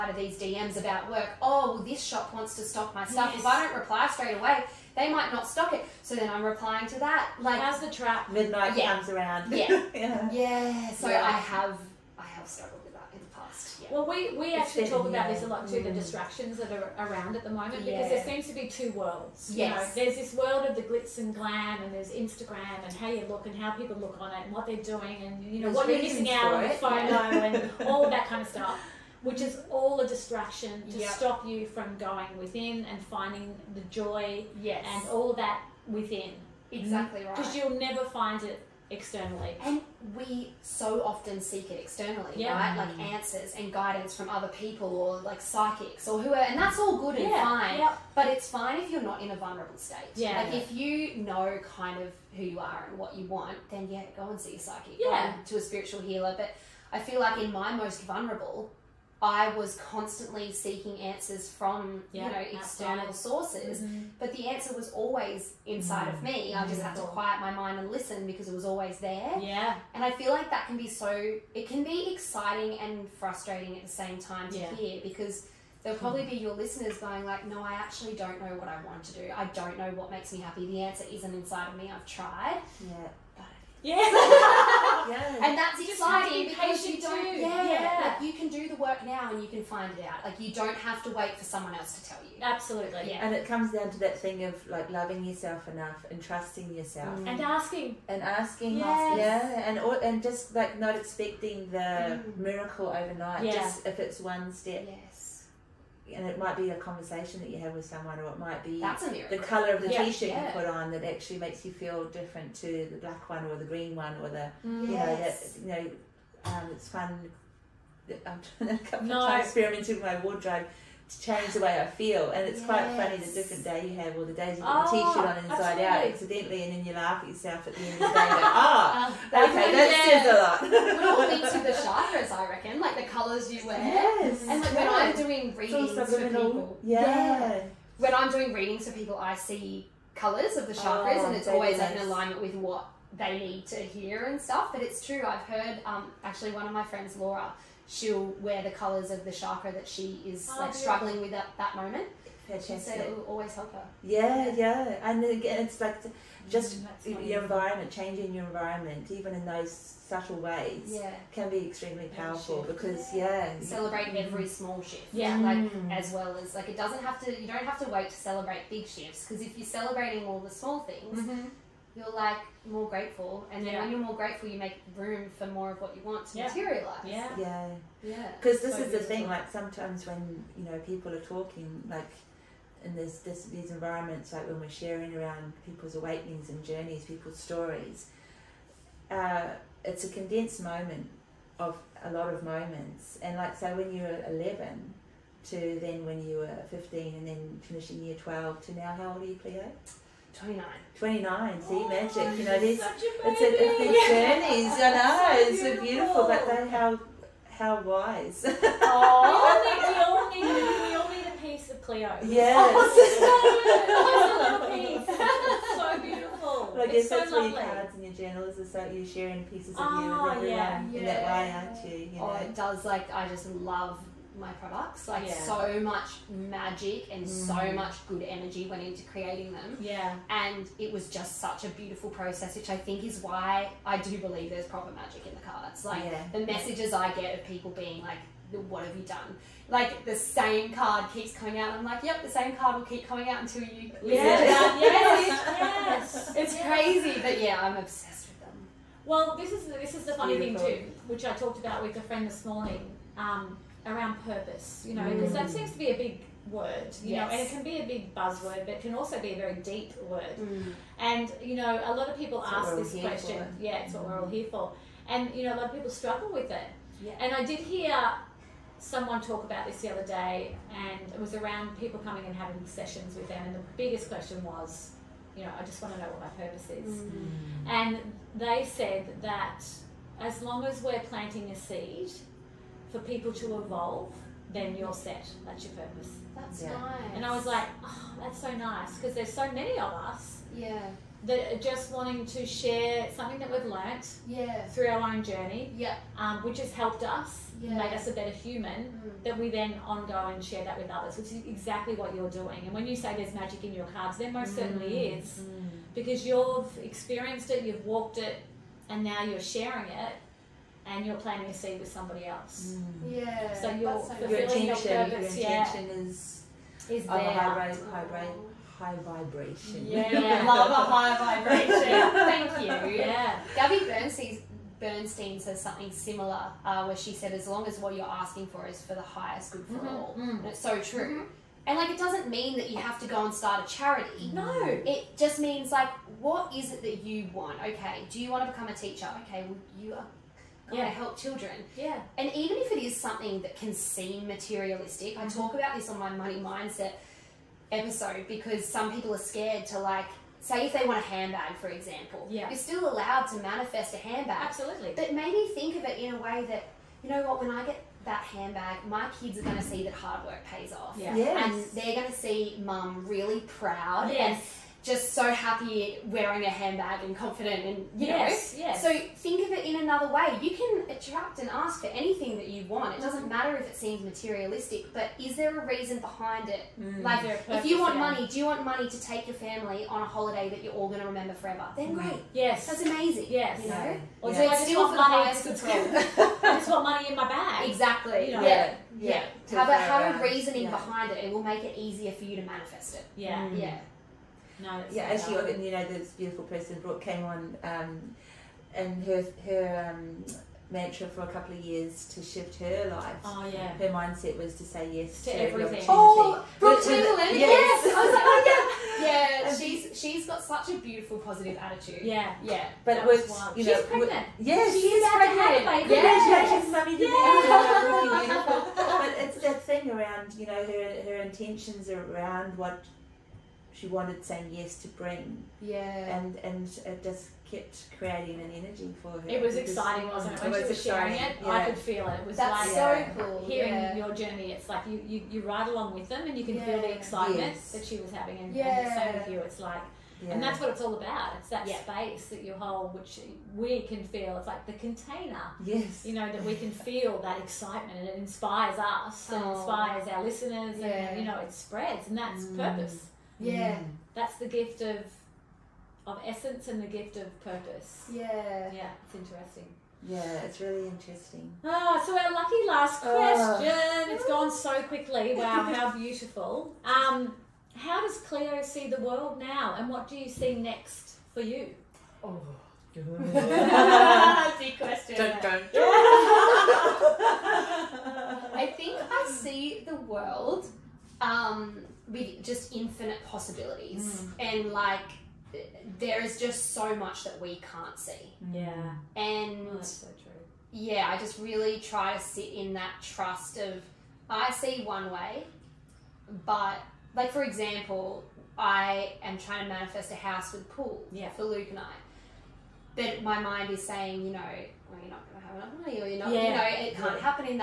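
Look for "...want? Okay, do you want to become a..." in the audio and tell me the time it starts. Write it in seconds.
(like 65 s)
337 s.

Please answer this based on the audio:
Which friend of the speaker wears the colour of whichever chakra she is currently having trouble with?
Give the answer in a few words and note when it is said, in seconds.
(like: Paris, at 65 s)
Laura, at 147 s.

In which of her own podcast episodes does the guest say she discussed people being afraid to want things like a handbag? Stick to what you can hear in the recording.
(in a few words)
Money mindset episode.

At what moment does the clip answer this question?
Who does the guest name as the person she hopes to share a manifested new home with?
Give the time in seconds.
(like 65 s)
501 s.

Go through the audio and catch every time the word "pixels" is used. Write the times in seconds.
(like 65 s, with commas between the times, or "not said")
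not said.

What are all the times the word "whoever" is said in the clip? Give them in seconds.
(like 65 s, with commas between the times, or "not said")
46 s.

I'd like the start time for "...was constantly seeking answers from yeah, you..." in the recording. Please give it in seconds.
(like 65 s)
59 s.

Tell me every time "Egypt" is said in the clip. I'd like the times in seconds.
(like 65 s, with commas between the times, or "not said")
not said.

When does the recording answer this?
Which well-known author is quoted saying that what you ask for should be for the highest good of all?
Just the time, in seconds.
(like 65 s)
323 s.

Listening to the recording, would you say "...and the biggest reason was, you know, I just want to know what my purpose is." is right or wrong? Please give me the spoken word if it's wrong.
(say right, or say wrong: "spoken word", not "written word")
wrong: "question", not "reason".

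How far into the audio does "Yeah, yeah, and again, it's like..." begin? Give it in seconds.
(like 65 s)
154 s.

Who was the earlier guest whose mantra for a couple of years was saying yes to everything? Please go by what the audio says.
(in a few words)
Brooke.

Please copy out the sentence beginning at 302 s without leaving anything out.
And when you say there's magic in your cards, there most mm.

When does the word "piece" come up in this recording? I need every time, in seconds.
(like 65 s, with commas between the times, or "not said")
211 s, 219 s.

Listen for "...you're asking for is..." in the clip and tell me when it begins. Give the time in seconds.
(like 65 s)
327 s.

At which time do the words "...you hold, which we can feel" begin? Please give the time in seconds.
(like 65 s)
442 s.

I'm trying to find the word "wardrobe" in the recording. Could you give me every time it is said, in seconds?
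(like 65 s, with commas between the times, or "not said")
120 s.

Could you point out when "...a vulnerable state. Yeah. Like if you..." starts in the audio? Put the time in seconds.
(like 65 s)
49 s.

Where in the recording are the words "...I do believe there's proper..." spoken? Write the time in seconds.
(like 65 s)
233 s.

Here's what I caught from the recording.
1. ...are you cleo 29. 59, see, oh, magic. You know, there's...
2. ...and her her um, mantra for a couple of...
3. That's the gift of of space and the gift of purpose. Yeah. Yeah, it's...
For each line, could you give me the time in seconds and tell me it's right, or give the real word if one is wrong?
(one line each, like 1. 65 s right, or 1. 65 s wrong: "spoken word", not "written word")
1. 199 s wrong: "29", not "59"
2. 398 s right
3. 454 s wrong: "essence", not "space".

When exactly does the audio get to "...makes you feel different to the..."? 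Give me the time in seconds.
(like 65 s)
111 s.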